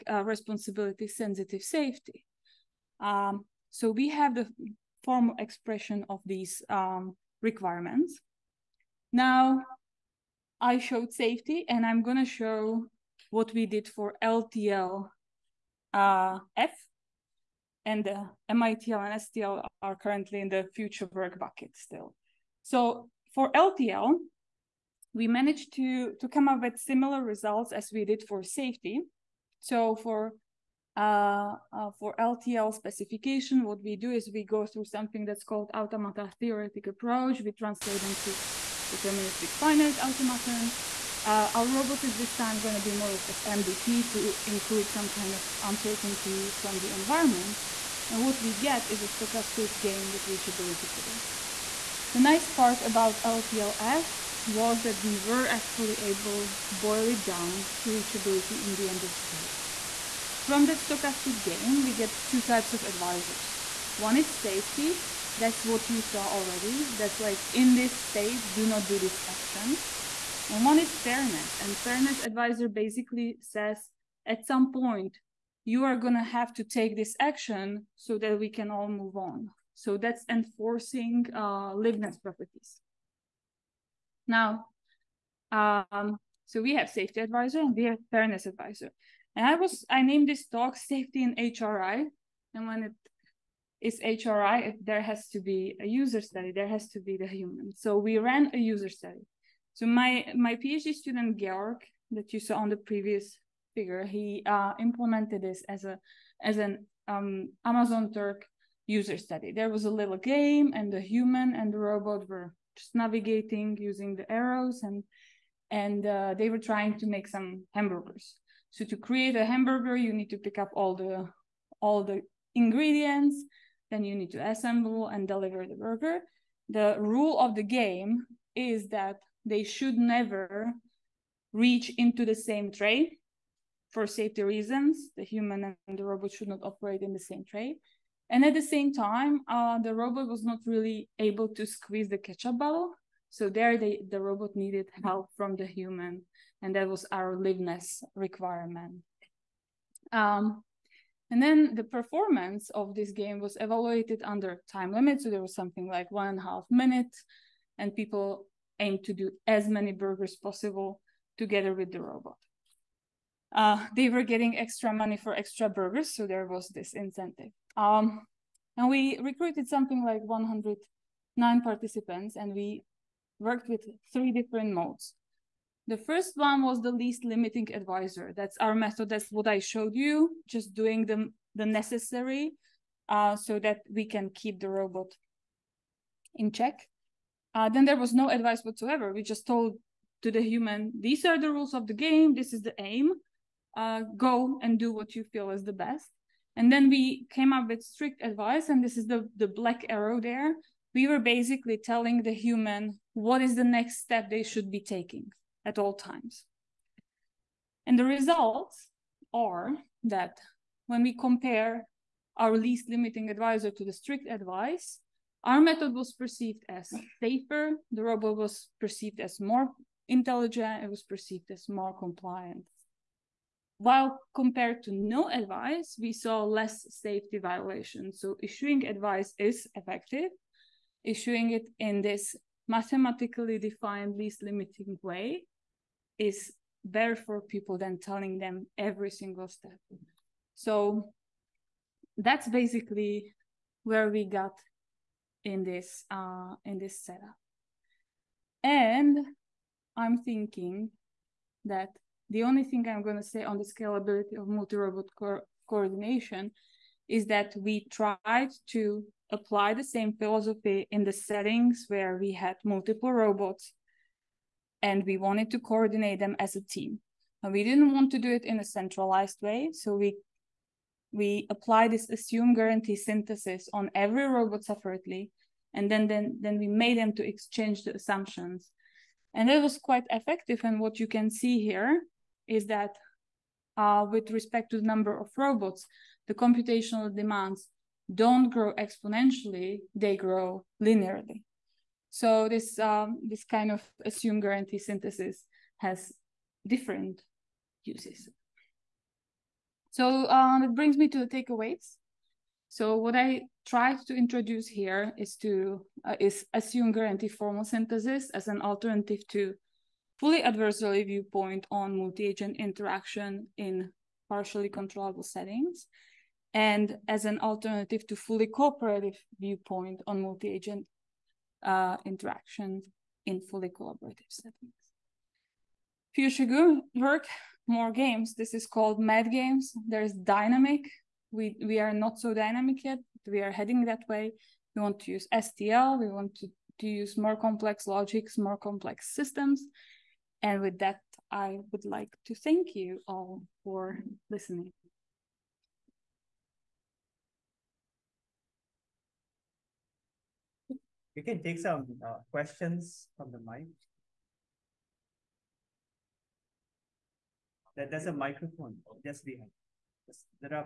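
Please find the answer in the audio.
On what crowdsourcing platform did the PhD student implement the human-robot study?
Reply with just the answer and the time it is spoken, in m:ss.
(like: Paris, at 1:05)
Amazon Turk, at 1:47.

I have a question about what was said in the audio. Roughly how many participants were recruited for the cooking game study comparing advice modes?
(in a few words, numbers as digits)
109.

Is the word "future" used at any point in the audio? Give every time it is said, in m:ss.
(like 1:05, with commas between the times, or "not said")
0:20, 5:26.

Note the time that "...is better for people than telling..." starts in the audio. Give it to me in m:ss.
3:56.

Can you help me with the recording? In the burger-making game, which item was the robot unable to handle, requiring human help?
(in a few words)
Ketchup bottle.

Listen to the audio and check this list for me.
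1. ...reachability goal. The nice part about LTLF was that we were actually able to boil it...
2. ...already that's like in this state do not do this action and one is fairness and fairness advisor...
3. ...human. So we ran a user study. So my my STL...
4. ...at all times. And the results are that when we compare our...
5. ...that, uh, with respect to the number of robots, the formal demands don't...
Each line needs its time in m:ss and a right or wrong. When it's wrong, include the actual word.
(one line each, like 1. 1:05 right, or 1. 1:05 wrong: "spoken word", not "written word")
1. 0:50 right
2. 1:06 right
3. 1:37 wrong: "PhD", not "STL"
4. 3:25 right
5. 4:42 wrong: "computational", not "formal".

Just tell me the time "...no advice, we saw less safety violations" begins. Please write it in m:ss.
3:44.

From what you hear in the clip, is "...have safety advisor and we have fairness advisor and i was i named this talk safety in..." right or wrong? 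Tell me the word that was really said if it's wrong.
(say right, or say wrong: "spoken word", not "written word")
right.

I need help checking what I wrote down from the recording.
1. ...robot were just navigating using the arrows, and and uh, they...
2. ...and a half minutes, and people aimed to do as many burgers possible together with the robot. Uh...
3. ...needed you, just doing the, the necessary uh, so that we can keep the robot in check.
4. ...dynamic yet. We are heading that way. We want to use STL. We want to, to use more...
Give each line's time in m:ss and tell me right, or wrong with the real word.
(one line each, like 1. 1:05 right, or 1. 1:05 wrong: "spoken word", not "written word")
1. 1:51 right
2. 2:36 right
3. 2:59 wrong: "showed", not "needed"
4. 5:32 right.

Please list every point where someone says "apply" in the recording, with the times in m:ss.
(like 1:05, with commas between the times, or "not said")
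4:19, 4:31.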